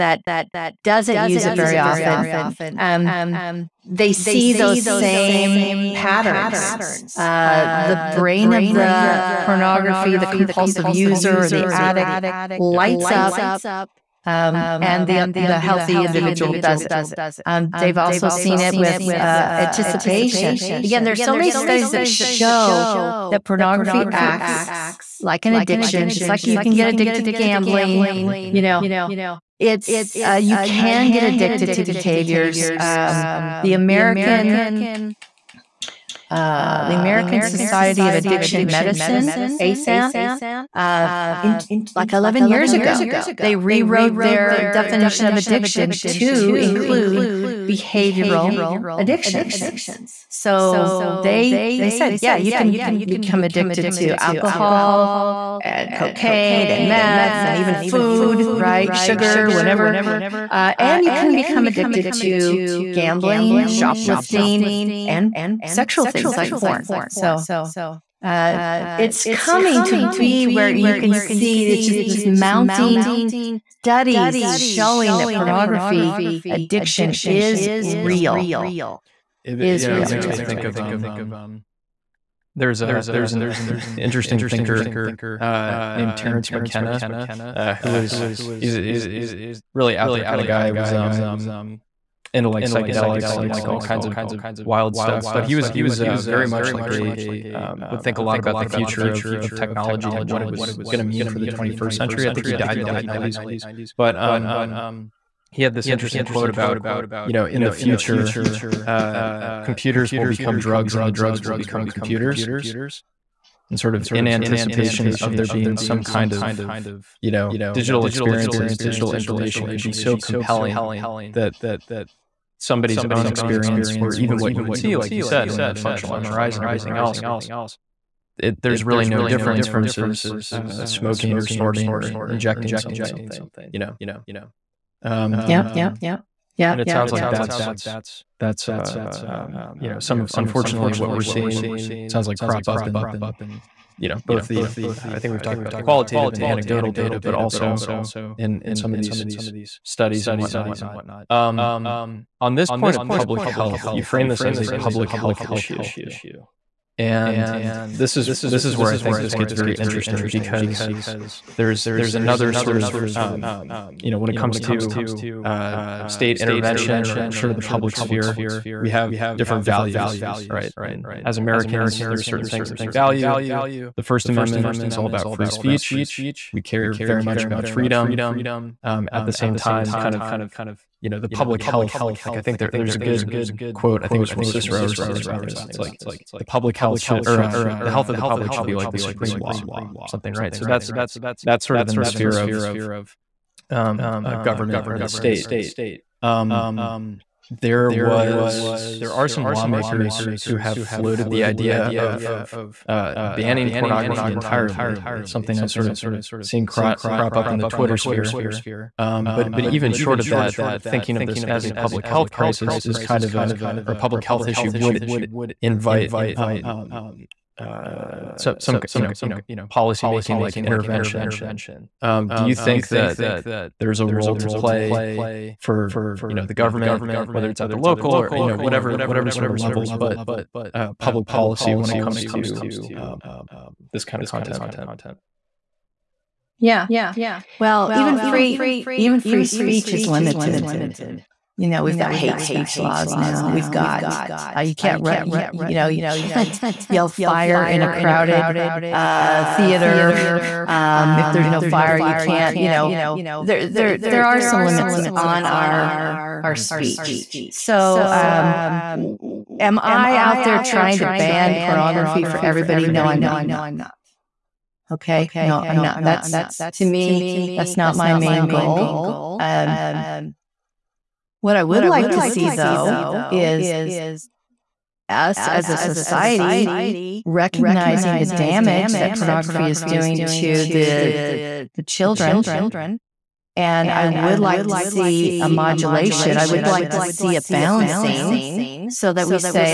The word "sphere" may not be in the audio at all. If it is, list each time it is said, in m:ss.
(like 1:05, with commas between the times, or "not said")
2:47, 3:12, 3:27.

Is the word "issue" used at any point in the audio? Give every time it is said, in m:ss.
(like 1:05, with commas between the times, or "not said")
2:35, 3:34.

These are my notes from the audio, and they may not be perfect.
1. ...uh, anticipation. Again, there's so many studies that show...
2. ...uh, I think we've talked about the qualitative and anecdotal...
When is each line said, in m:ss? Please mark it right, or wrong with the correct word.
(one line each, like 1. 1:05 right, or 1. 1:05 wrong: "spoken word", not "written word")
1. 0:19 right
2. 2:25 right.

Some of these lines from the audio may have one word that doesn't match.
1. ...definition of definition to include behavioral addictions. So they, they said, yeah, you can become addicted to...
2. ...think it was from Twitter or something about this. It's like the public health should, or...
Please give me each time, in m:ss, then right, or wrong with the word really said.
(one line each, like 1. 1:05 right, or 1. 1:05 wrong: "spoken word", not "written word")
1. 0:44 wrong: "addiction", not "definition"
2. 3:04 wrong: "Cicero", not "Twitter".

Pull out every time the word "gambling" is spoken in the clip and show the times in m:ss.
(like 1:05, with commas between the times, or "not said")
0:27, 1:02.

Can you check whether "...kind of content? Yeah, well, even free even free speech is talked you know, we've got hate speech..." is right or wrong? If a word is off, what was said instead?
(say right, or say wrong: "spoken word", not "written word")
wrong: "limited", not "talked".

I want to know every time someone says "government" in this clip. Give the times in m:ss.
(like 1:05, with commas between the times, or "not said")
3:14, 3:46.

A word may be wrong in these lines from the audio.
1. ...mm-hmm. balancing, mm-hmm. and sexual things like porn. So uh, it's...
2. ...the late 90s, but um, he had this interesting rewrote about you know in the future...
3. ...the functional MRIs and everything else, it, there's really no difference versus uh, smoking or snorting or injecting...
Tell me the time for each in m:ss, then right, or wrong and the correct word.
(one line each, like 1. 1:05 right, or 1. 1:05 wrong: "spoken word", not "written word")
1. 1:03 wrong: "shoplifting", not "balancing"
2. 1:42 wrong: "quote", not "rewrote"
3. 2:05 right.